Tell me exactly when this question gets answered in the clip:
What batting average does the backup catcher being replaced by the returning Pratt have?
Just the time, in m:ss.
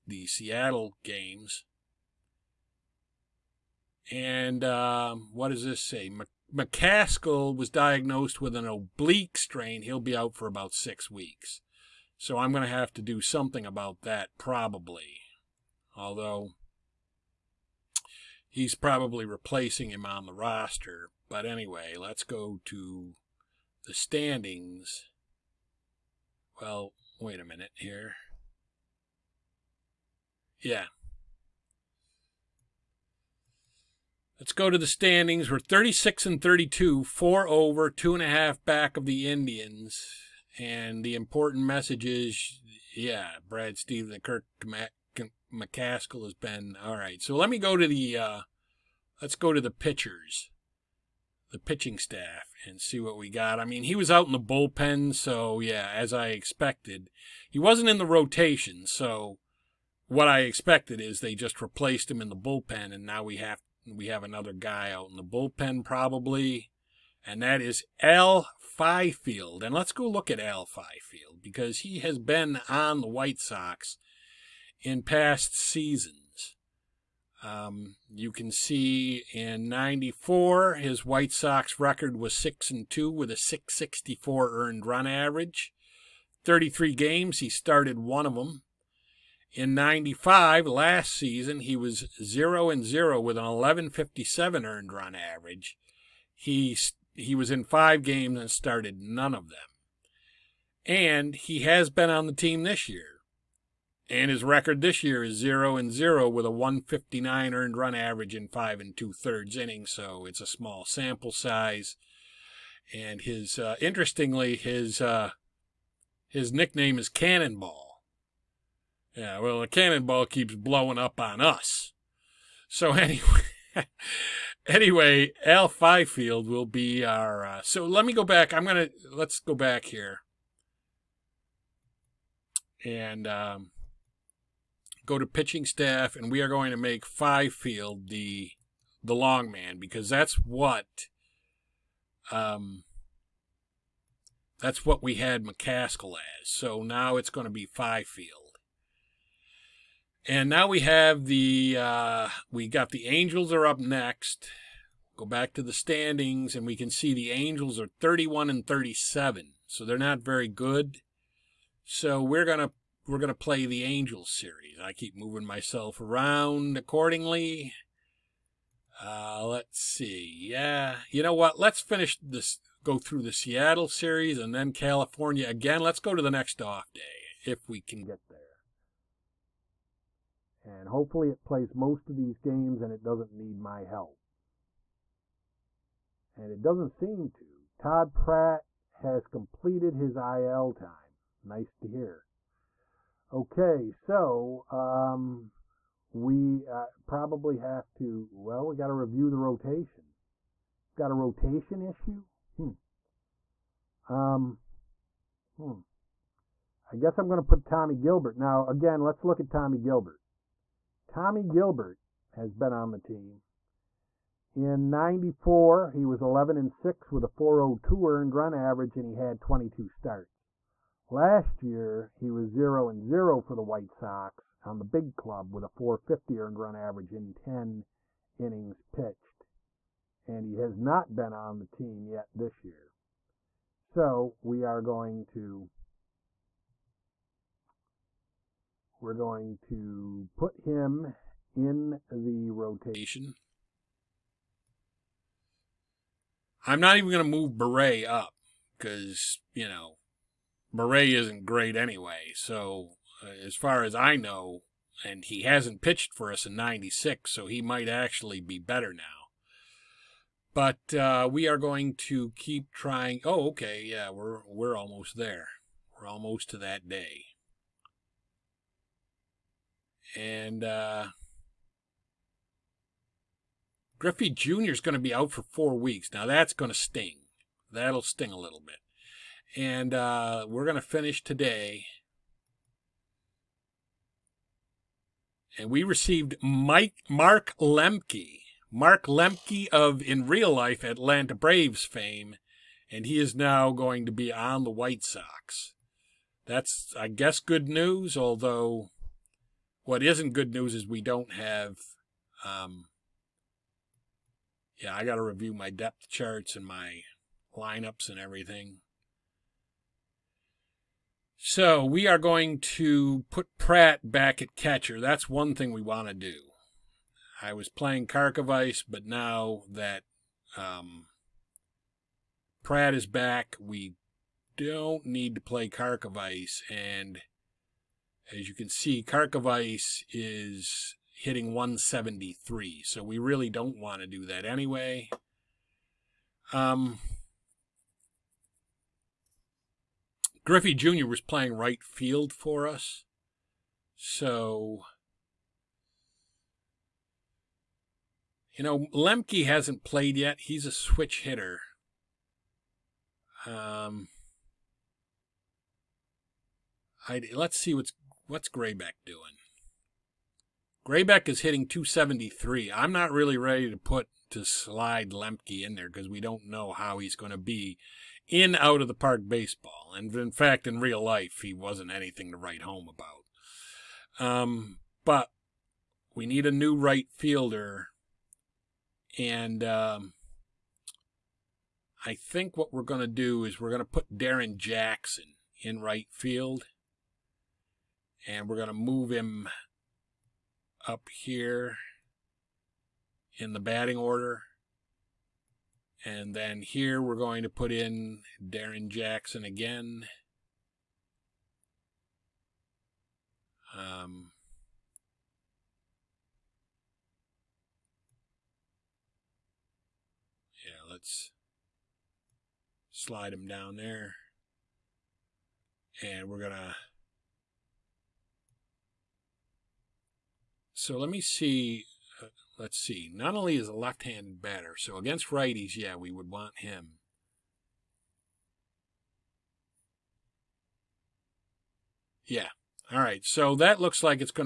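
5:31.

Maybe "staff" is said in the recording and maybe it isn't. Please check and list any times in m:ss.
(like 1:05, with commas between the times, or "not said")
0:51, 2:15.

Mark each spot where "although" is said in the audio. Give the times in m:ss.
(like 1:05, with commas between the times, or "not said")
0:15, 4:58.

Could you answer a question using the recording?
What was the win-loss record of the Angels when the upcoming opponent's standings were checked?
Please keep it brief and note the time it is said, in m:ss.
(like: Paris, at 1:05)
31 and 37, at 2:37.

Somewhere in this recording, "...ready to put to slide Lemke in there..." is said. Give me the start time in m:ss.
6:03.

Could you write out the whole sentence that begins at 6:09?
And in fact, in real life, he wasn't anything to write home about.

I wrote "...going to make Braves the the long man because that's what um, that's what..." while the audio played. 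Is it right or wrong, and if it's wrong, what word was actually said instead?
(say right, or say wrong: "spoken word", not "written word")
wrong: "Fifield", not "Braves".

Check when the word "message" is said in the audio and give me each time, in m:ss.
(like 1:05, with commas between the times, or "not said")
0:41.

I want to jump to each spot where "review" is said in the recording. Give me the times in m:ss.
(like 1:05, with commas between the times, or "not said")
3:18, 5:05.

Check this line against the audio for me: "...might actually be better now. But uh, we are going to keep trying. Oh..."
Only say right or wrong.
right.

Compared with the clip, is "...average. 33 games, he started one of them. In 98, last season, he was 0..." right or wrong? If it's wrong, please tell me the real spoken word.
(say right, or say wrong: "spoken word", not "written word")
wrong: "95", not "98".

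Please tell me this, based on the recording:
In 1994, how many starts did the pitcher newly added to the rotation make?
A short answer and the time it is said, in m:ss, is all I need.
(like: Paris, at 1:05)
22, at 3:39.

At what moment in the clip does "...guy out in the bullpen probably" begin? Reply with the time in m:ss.
1:04.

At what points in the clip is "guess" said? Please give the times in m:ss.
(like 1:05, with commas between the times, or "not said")
3:26, 4:57.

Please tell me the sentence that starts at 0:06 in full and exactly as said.
McCaskill was diagnosed with an oblique strain.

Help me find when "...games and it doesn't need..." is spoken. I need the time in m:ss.
3:02.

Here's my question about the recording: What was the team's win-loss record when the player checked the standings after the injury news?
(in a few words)
36 and 32.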